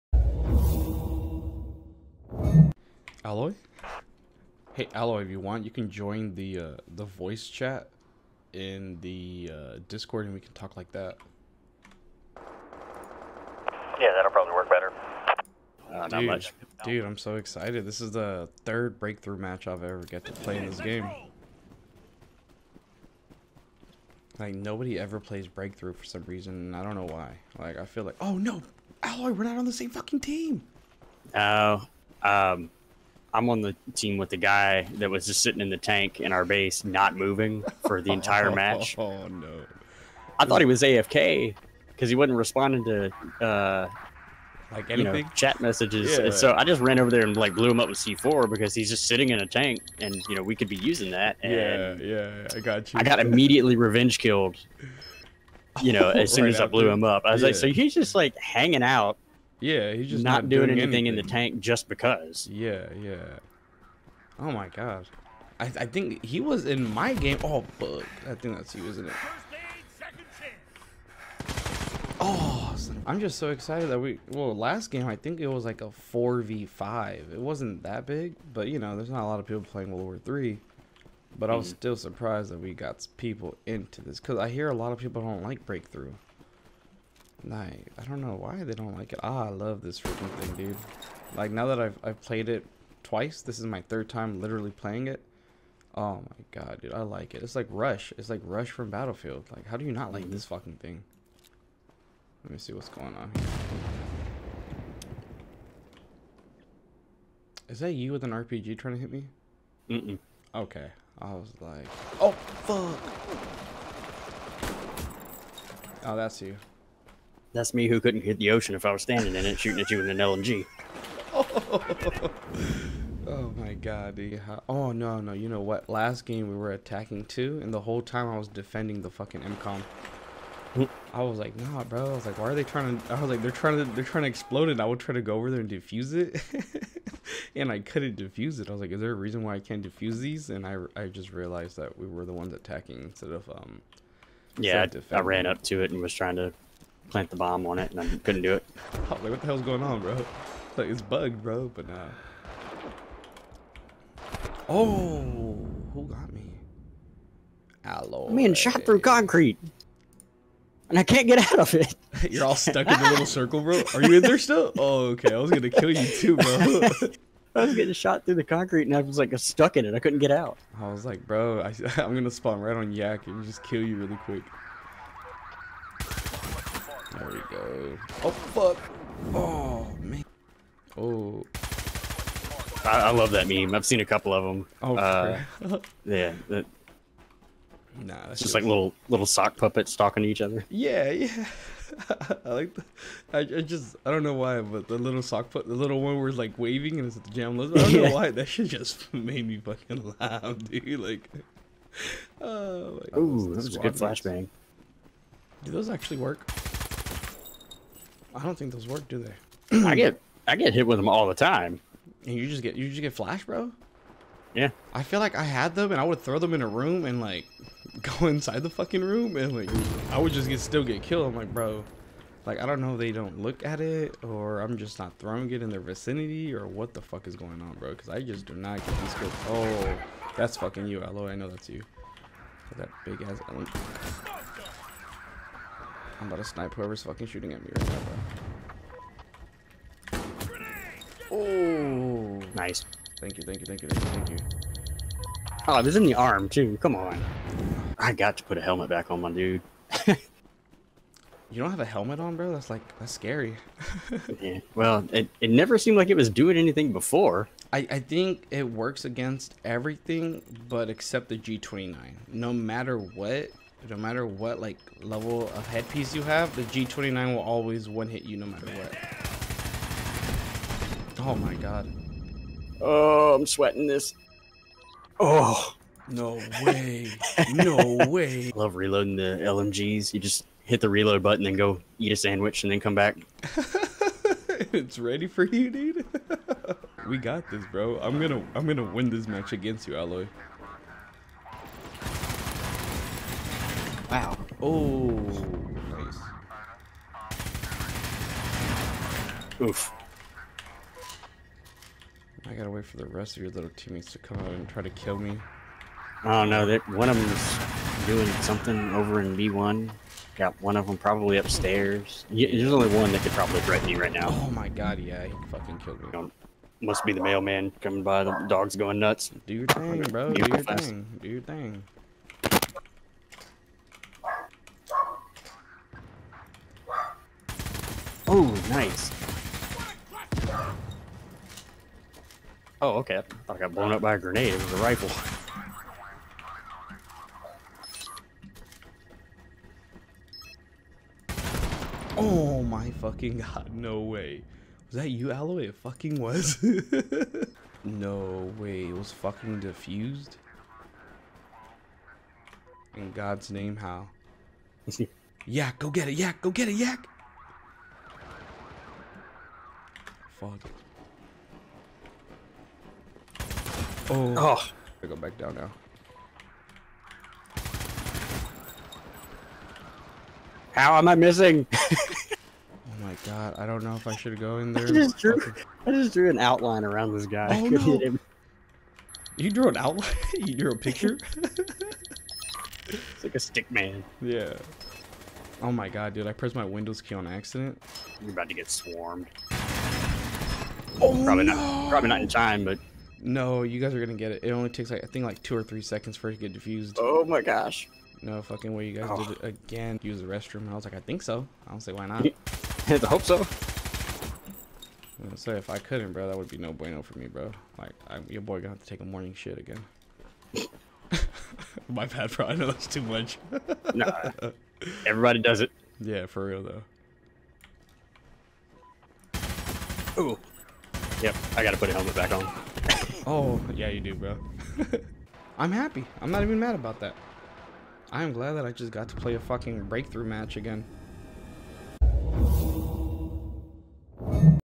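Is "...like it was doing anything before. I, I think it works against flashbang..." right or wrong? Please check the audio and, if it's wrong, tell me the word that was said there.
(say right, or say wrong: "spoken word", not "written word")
wrong: "everything", not "flashbang".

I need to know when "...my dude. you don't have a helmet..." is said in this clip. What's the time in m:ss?
4:09.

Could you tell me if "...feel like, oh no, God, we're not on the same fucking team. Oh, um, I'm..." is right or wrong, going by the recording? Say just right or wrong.
wrong.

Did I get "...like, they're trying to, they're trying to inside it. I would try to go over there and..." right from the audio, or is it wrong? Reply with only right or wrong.
wrong.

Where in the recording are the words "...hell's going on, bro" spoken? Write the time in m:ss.
2:29.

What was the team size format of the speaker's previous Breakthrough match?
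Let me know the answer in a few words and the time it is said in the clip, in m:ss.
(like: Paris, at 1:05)
4v5, at 1:16.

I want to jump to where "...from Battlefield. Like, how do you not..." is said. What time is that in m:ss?
1:38.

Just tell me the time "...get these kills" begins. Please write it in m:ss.
3:48.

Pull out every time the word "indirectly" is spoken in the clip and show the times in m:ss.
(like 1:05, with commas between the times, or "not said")
not said.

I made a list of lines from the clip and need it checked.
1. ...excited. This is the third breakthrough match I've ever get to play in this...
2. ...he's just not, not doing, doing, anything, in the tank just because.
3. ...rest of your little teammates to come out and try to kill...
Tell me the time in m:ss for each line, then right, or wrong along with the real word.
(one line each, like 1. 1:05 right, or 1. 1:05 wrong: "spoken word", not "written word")
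1. 0:17 right
2. 0:59 right
3. 5:03 right.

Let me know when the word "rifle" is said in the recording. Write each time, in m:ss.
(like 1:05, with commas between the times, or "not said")
5:34.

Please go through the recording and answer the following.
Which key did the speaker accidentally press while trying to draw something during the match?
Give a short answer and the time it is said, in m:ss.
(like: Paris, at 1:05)
Windows key, at 6:26.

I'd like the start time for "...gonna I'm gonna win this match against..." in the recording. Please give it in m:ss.
4:48.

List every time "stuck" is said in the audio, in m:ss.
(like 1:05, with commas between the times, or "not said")
2:42, 2:49.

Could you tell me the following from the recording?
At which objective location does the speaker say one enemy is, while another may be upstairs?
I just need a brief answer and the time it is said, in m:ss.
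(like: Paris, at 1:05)
B1, at 5:09.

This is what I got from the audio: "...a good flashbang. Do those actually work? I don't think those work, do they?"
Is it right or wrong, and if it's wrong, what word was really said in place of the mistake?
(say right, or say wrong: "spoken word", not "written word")
right.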